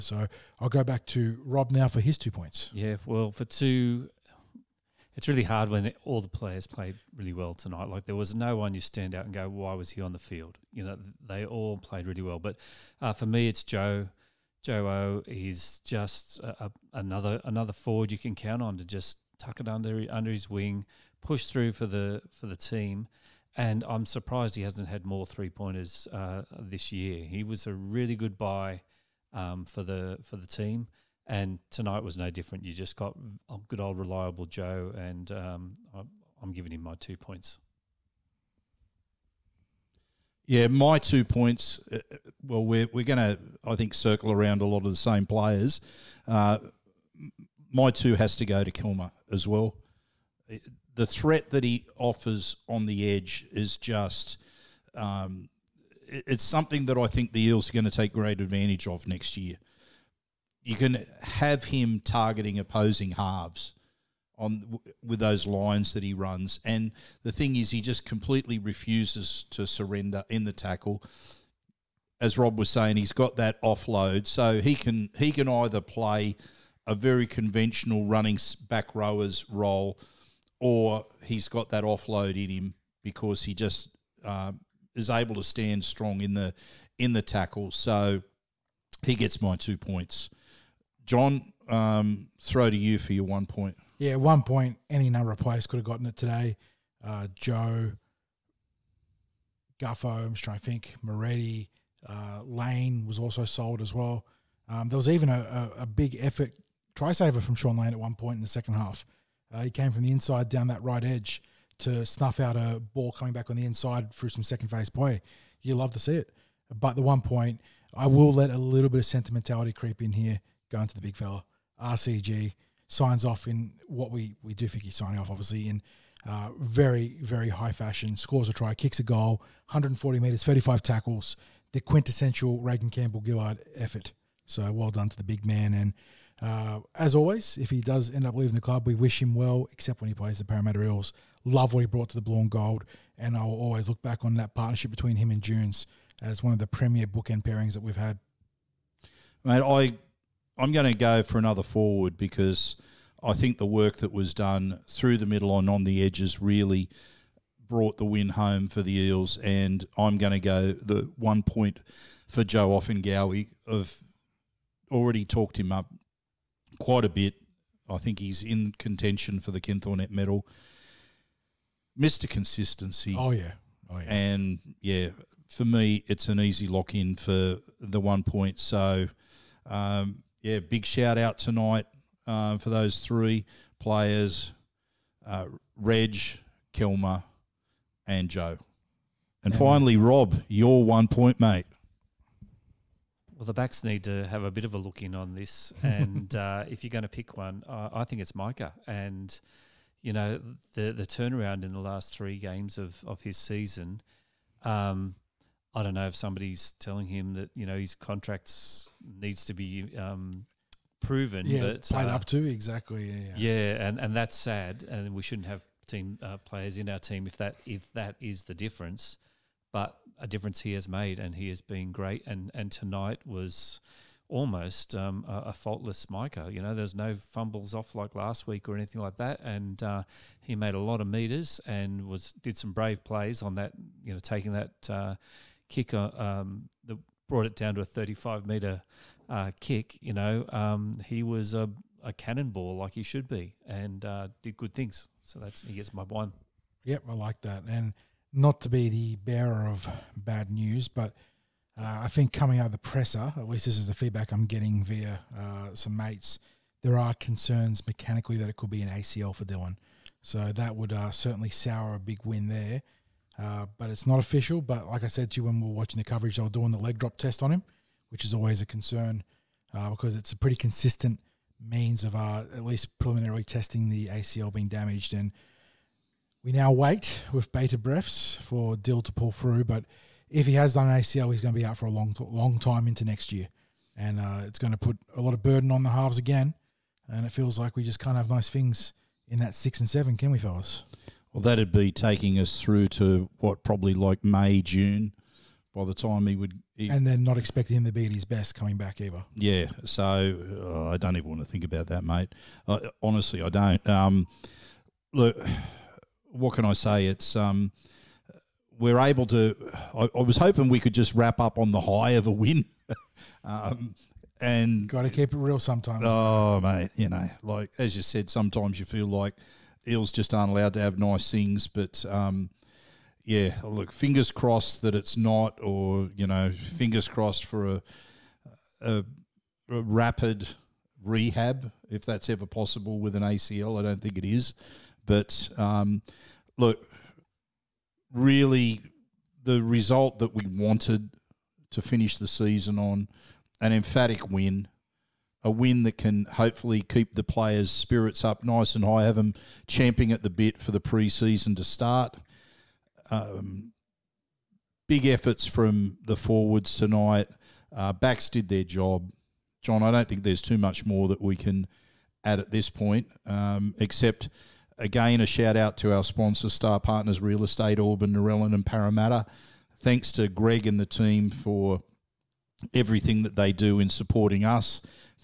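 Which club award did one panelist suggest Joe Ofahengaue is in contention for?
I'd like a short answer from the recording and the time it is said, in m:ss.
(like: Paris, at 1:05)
Ken Thornett medal, at 2:49.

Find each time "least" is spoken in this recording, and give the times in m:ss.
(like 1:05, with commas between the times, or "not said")
4:13, 4:32.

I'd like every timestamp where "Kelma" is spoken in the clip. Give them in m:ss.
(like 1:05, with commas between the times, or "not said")
0:48, 3:06.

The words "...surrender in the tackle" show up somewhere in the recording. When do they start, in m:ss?
1:09.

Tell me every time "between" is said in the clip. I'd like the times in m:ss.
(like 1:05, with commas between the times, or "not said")
2:24.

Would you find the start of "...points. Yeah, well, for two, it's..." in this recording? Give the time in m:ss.
0:02.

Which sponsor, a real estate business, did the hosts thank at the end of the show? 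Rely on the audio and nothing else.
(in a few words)
Star Partners Real Estate.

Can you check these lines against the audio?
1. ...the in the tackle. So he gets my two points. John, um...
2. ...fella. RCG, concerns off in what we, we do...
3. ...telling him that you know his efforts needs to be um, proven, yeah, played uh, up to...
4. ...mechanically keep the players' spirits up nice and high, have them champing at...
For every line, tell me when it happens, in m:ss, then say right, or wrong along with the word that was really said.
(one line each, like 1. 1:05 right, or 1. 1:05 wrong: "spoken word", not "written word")
1. 1:26 right
2. 2:01 wrong: "signs", not "concerns"
3. 3:26 wrong: "contracts", not "efforts"
4. 5:46 wrong: "hopefully", not "mechanically".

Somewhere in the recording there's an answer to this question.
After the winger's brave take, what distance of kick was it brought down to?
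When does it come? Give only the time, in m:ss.
3:57.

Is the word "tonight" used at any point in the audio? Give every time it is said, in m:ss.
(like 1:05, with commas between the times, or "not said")
0:07, 0:31, 3:01, 3:42, 5:56.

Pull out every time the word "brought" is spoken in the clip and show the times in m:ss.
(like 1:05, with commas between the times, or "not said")
2:21, 2:37, 3:57.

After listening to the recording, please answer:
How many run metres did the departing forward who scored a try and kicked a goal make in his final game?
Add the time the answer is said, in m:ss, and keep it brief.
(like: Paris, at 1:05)
140, at 2:09.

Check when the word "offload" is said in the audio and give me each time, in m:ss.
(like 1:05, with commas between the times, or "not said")
1:13, 1:21.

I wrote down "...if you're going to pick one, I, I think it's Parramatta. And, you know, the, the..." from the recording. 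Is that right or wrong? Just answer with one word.
wrong.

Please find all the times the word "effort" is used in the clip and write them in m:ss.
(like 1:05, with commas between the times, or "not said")
1:46, 2:13, 5:55.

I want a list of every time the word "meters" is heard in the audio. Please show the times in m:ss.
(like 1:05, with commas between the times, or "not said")
3:51, 3:58.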